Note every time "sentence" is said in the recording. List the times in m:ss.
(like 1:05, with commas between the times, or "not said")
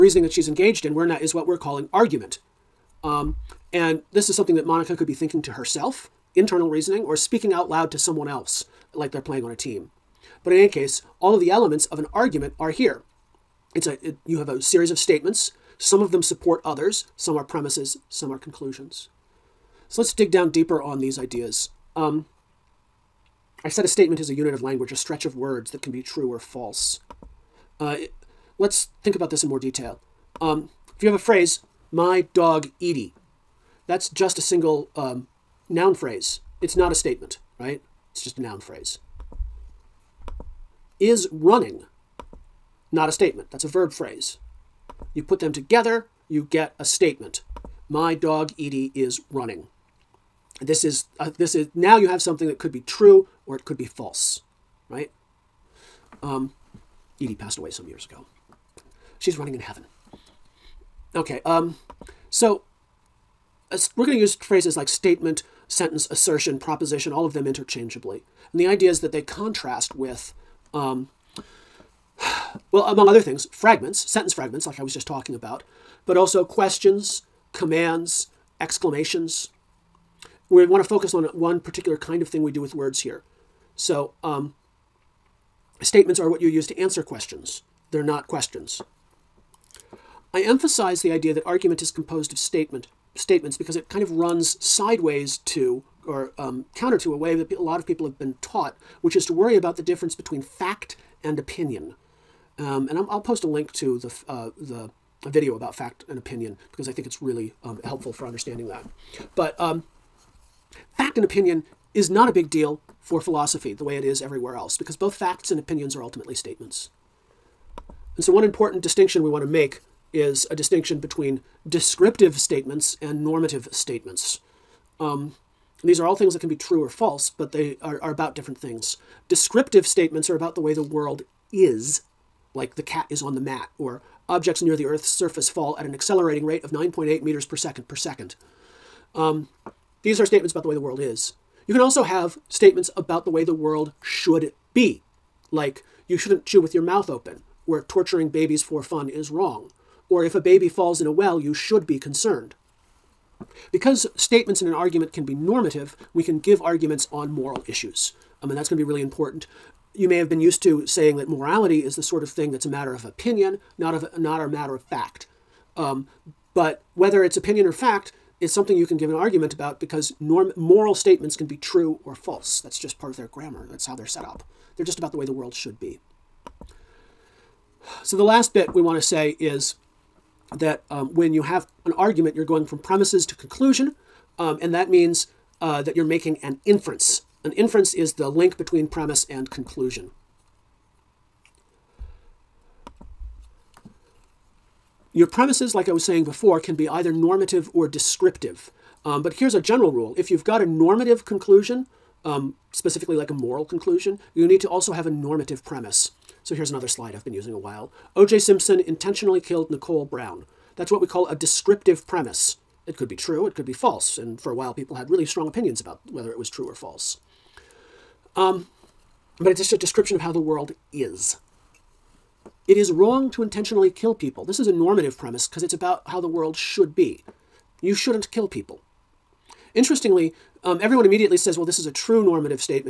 1:05, 1:13.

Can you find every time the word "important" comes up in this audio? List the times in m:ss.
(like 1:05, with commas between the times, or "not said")
1:58, 2:39.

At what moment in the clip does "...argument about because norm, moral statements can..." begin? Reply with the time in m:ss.
2:49.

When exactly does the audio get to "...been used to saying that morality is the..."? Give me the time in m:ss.
2:40.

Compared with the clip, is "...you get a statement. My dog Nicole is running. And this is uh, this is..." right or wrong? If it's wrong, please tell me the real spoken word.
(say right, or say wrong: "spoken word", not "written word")
wrong: "Edie", not "Nicole".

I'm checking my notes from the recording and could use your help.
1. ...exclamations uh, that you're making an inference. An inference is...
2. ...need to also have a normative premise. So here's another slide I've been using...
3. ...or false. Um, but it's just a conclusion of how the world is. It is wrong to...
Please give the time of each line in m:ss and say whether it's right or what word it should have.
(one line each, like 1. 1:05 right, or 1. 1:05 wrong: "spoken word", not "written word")
1. 3:04 wrong: "means", not "exclamations"
2. 3:24 right
3. 3:36 wrong: "description", not "conclusion".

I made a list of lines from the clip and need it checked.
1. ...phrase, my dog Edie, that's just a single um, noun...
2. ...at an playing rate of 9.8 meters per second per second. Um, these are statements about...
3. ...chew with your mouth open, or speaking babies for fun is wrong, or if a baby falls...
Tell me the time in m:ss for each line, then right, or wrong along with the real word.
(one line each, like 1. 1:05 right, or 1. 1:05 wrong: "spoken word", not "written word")
1. 0:31 right
2. 2:15 wrong: "accelerating", not "playing"
3. 2:26 wrong: "torturing", not "speaking".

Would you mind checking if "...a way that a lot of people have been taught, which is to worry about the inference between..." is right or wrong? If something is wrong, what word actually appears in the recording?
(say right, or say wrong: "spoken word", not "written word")
wrong: "difference", not "inference".